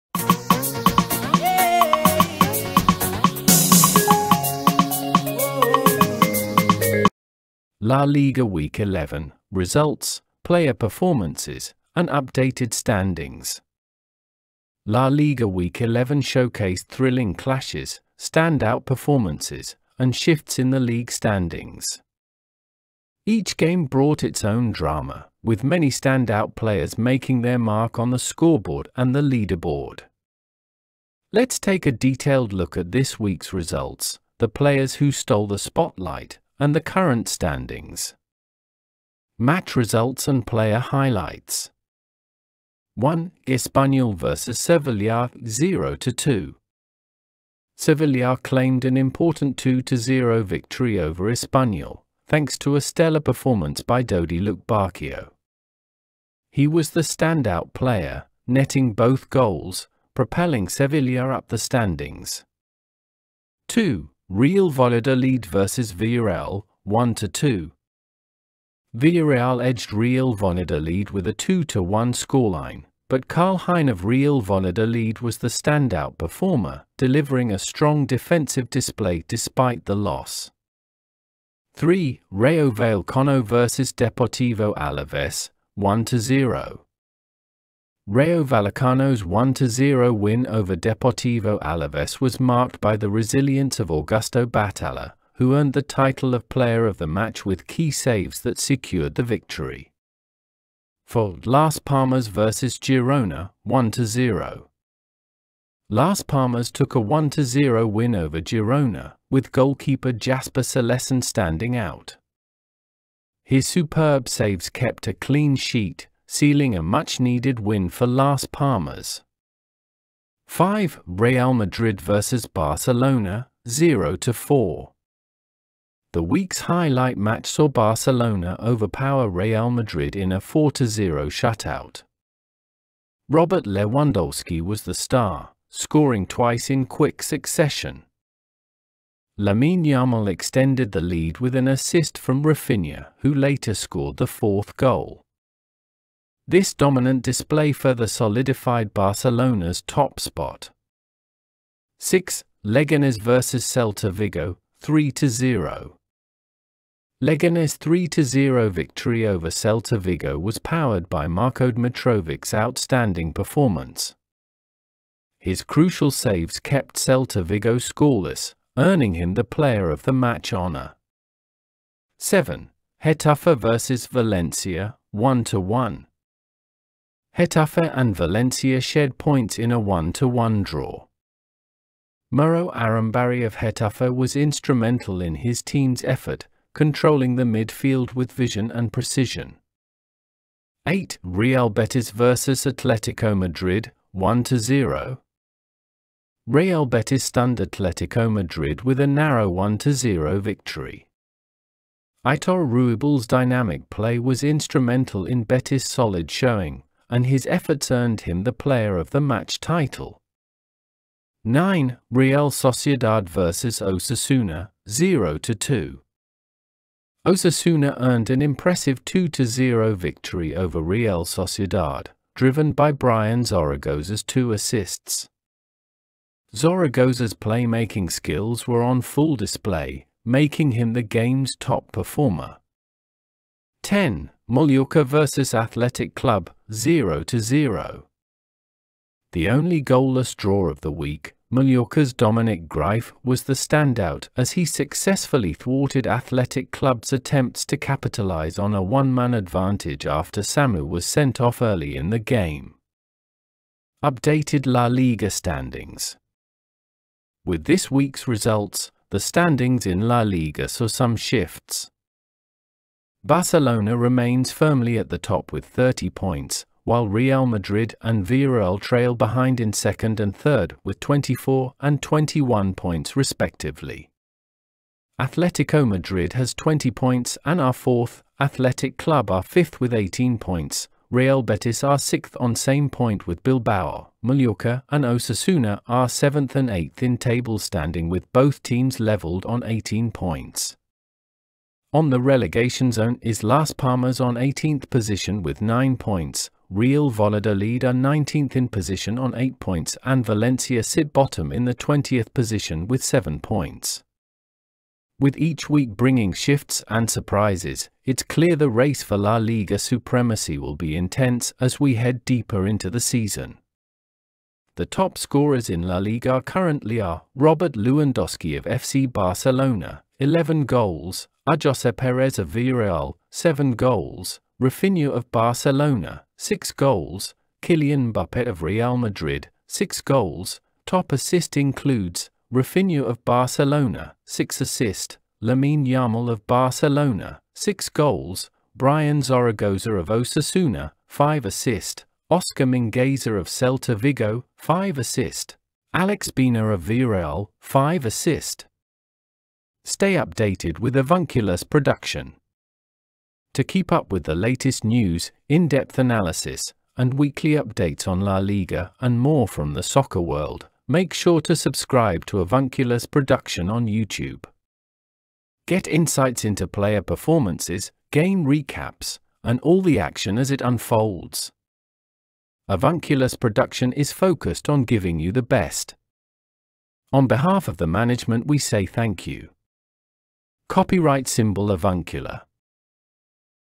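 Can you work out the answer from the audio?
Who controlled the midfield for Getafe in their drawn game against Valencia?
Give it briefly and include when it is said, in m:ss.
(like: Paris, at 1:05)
Mauro Arambarri, at 3:02.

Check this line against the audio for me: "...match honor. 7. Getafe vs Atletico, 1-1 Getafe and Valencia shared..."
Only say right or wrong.
wrong.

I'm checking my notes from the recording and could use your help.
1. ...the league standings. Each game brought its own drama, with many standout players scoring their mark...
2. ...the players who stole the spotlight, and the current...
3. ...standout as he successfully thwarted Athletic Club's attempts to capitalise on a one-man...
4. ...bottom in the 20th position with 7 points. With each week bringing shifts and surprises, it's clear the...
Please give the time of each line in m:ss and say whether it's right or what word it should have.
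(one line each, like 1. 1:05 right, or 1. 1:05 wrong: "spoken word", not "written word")
1. 0:20 wrong: "making", not "scoring"
2. 0:34 right
3. 4:03 right
4. 5:01 right.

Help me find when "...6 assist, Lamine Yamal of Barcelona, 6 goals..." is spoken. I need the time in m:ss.
5:34.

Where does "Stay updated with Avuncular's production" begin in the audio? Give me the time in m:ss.
5:49.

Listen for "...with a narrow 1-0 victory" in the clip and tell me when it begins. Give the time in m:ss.
3:18.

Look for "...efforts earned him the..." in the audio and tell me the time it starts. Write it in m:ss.
3:27.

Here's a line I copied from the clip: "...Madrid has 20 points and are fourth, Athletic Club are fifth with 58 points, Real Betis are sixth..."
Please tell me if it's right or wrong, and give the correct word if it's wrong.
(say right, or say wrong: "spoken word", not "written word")
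wrong: "18", not "58".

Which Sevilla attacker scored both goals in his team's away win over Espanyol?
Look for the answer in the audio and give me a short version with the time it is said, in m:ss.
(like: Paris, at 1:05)
Dodi Lukebakio, at 0:54.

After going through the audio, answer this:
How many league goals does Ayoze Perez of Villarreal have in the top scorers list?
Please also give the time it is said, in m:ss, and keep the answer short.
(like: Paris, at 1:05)
7, at 5:23.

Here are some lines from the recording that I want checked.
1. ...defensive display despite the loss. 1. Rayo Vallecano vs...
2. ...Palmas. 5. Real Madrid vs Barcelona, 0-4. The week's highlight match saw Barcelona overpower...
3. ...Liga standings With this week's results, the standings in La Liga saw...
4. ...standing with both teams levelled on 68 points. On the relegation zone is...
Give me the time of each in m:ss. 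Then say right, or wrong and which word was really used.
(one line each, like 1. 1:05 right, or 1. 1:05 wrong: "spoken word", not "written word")
1. 1:18 wrong: "3", not "1"
2. 1:58 right
3. 4:14 right
4. 4:47 wrong: "18", not "68".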